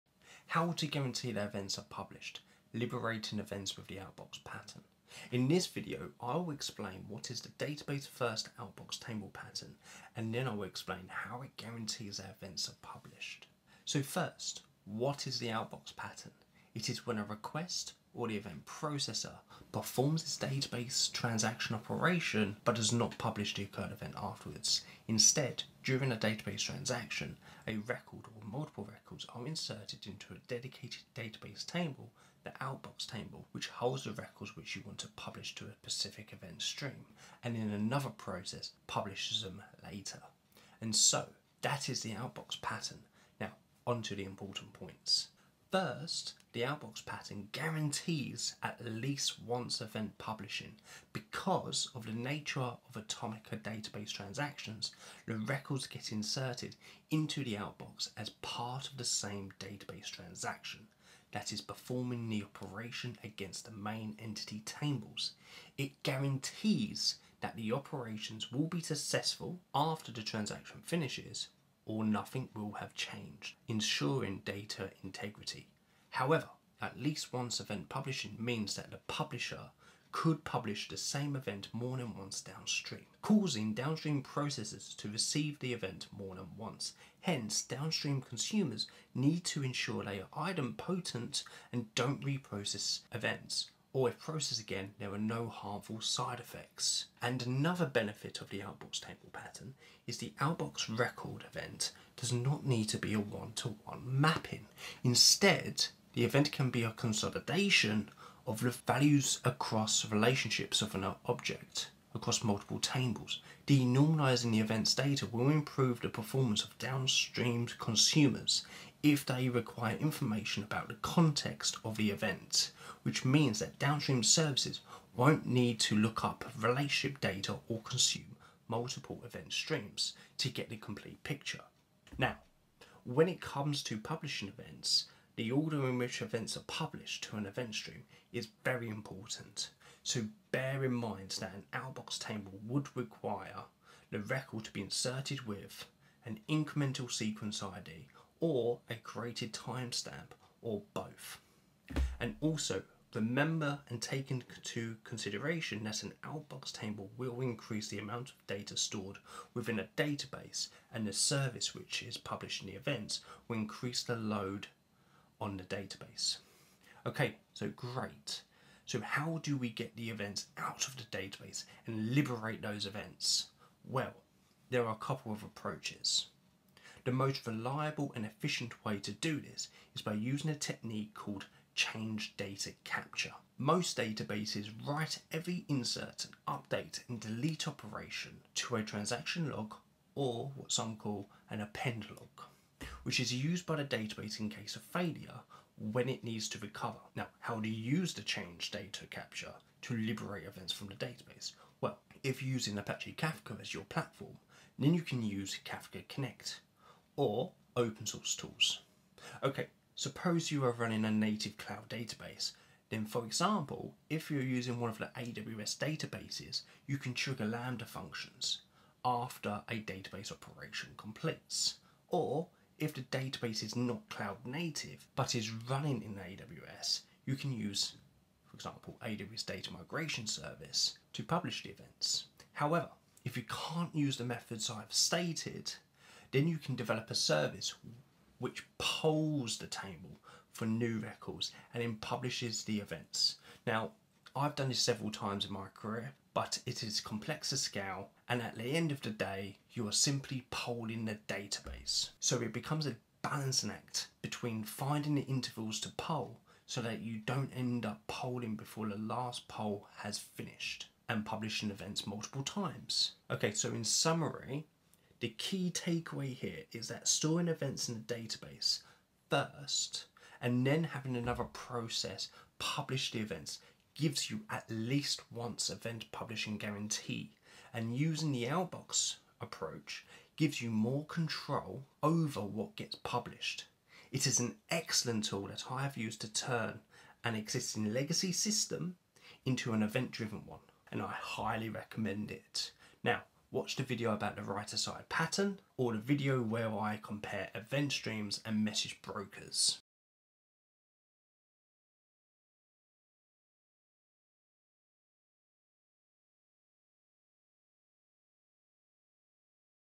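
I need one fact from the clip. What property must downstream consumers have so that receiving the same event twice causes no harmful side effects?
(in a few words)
Idempotent.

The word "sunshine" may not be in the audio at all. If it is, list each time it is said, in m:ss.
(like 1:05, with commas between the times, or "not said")
not said.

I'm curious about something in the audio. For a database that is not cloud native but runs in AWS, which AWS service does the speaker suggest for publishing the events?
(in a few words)
AWS Data Migration Service.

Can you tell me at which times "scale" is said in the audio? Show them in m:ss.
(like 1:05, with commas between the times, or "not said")
4:07.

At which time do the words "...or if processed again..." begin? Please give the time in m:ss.
1:33.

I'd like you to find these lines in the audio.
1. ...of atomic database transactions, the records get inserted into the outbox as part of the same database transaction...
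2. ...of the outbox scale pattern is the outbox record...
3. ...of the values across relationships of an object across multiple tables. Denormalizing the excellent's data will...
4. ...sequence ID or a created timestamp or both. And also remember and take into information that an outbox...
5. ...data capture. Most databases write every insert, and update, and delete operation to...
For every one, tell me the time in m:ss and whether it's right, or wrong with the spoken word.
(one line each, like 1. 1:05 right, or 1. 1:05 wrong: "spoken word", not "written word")
1. 0:52 right
2. 1:38 wrong: "table", not "scale"
3. 1:48 wrong: "event", not "excellent"
4. 2:27 wrong: "consideration", not "information"
5. 3:02 right.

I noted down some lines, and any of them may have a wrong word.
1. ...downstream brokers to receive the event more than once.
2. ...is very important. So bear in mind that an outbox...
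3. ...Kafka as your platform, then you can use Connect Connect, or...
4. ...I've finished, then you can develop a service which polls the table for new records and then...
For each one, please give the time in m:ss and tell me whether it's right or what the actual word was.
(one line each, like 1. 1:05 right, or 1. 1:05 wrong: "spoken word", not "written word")
1. 1:23 wrong: "processors", not "brokers"
2. 2:18 right
3. 3:23 wrong: "Kafka", not "Connect"
4. 3:54 wrong: "stated", not "finished".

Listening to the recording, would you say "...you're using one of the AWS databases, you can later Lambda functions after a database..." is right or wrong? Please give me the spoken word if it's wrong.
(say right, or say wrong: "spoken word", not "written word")
wrong: "trigger", not "later".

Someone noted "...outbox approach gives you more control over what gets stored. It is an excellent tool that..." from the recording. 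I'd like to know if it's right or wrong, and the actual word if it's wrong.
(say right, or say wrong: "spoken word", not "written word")
wrong: "published", not "stored".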